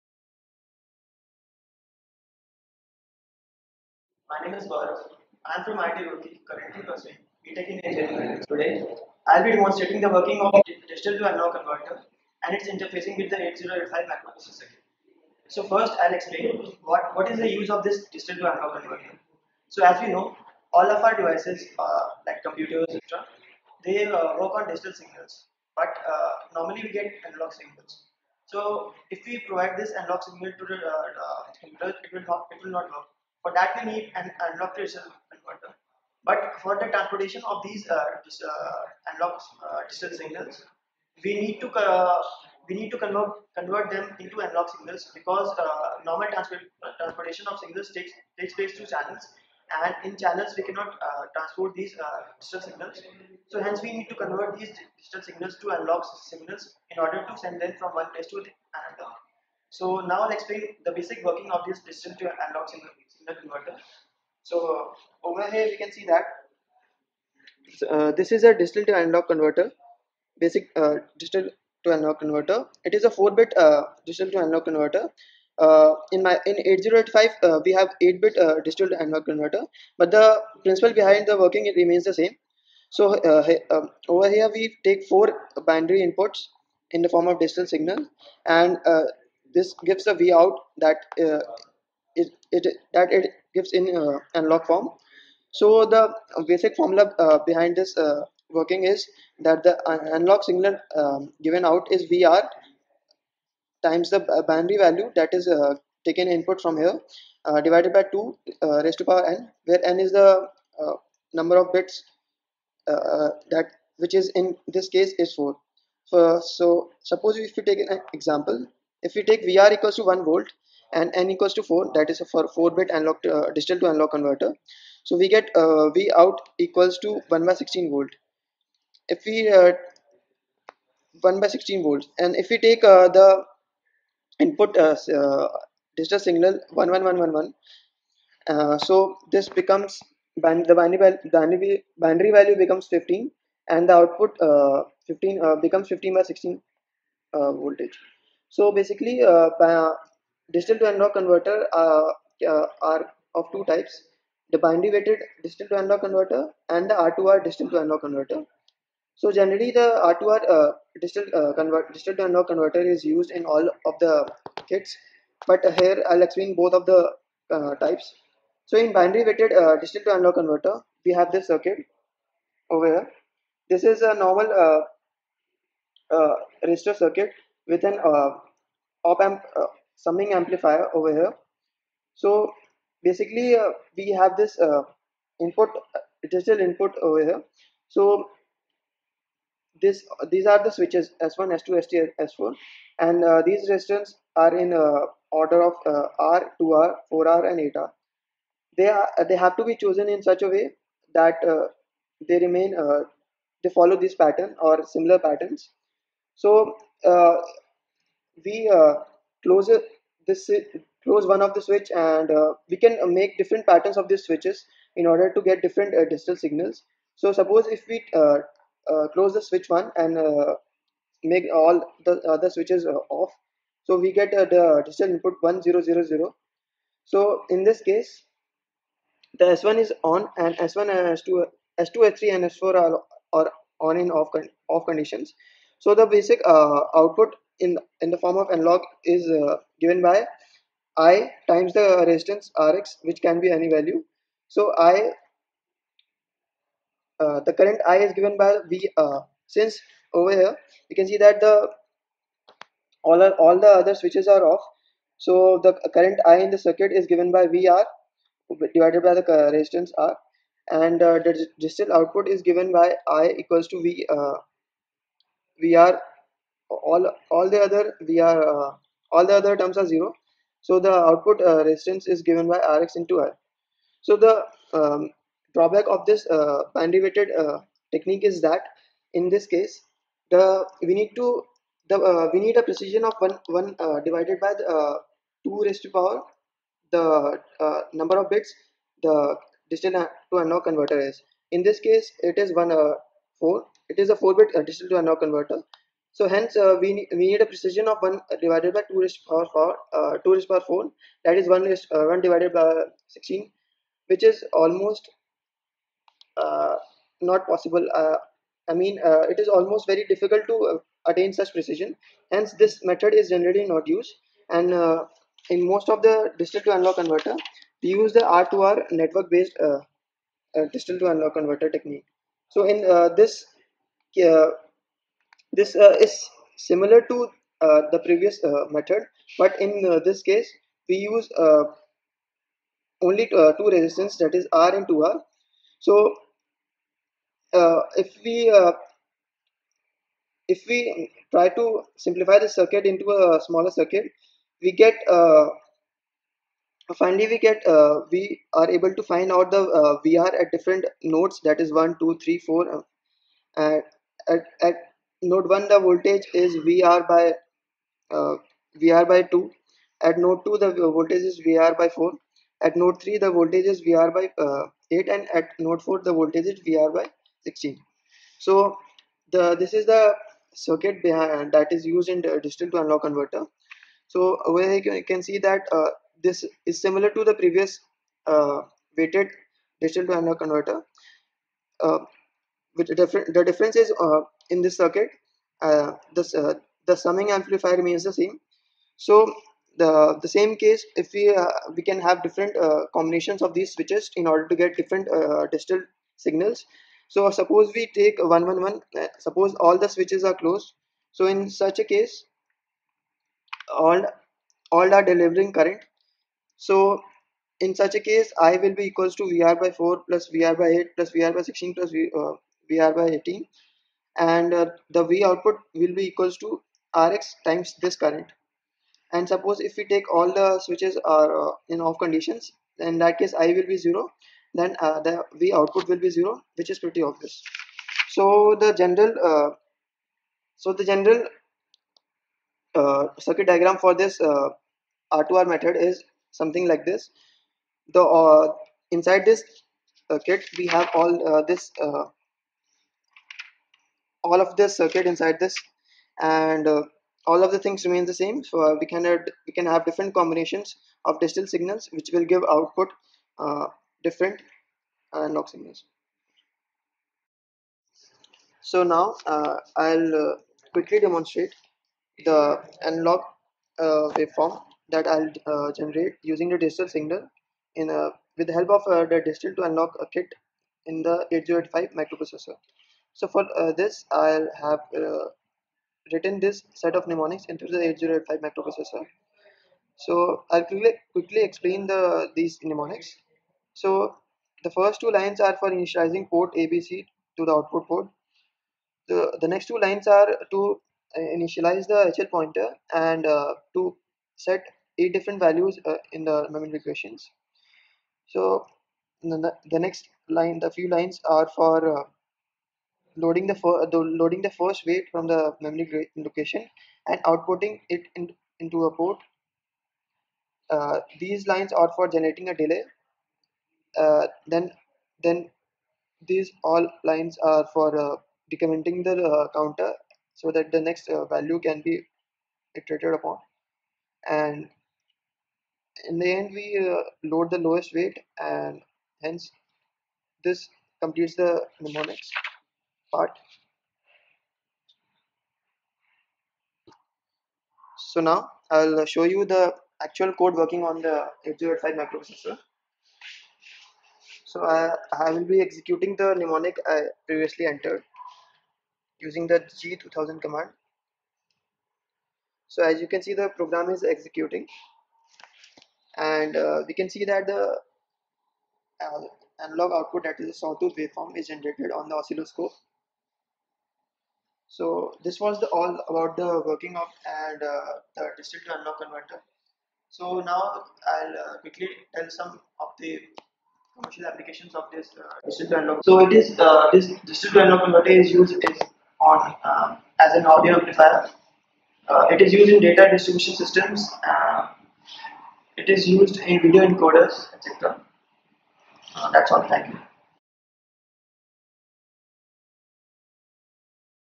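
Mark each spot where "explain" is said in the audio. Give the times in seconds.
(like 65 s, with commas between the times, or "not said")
16 s, 60 s, 166 s, 481 s.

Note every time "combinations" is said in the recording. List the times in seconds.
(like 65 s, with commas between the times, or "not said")
392 s, 450 s.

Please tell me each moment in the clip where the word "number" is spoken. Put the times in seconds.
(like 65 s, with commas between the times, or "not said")
111 s, 287 s.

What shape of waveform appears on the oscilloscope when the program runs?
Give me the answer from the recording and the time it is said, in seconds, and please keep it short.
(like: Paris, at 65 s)
sawtooth, at 560 s.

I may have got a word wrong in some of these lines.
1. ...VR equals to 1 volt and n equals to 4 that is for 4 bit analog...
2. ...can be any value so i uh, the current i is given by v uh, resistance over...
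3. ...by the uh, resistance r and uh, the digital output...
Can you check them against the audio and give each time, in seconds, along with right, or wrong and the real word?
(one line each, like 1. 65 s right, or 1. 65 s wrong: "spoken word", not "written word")
1. 119 s right
2. 243 s wrong: "since", not "resistance"
3. 259 s right.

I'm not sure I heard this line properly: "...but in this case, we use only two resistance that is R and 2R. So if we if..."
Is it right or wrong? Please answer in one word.
right.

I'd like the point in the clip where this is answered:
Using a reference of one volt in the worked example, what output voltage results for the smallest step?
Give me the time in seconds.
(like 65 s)
127 s.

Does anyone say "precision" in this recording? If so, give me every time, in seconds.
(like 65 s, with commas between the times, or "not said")
282 s, 297 s, 311 s.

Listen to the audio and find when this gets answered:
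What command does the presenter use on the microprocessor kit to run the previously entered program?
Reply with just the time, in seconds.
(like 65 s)
549 s.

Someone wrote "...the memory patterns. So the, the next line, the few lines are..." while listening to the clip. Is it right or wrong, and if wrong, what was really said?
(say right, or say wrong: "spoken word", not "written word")
wrong: "locations", not "patterns".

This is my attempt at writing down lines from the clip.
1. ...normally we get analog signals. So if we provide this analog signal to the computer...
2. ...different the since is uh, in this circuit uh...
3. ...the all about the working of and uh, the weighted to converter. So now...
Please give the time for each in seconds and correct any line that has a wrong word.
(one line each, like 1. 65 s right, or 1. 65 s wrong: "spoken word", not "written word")
1. 26 s right
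2. 382 s wrong: "difference", not "since"
3. 565 s wrong: "distributed", not "weighted".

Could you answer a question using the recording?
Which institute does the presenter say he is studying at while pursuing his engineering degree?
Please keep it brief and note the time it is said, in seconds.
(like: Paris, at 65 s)
IIT Roorkee, at 5 s.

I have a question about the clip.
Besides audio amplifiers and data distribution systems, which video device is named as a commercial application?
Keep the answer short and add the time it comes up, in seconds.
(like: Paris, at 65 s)
video encoders, at 586 s.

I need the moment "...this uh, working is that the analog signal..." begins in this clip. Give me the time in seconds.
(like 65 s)
97 s.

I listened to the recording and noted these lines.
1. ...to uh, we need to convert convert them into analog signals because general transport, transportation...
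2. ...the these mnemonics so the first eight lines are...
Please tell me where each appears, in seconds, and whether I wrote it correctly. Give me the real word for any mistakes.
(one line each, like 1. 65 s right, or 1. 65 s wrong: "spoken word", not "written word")
1. 41 s wrong: "normal", not "general"
2. 481 s wrong: "two", not "eight".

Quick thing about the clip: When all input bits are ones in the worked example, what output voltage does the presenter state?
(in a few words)
15/16 volt.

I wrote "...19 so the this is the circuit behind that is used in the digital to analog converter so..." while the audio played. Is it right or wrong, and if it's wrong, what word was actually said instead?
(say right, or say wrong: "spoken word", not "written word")
wrong: "16", not "19".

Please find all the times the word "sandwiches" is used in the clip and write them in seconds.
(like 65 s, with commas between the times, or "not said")
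not said.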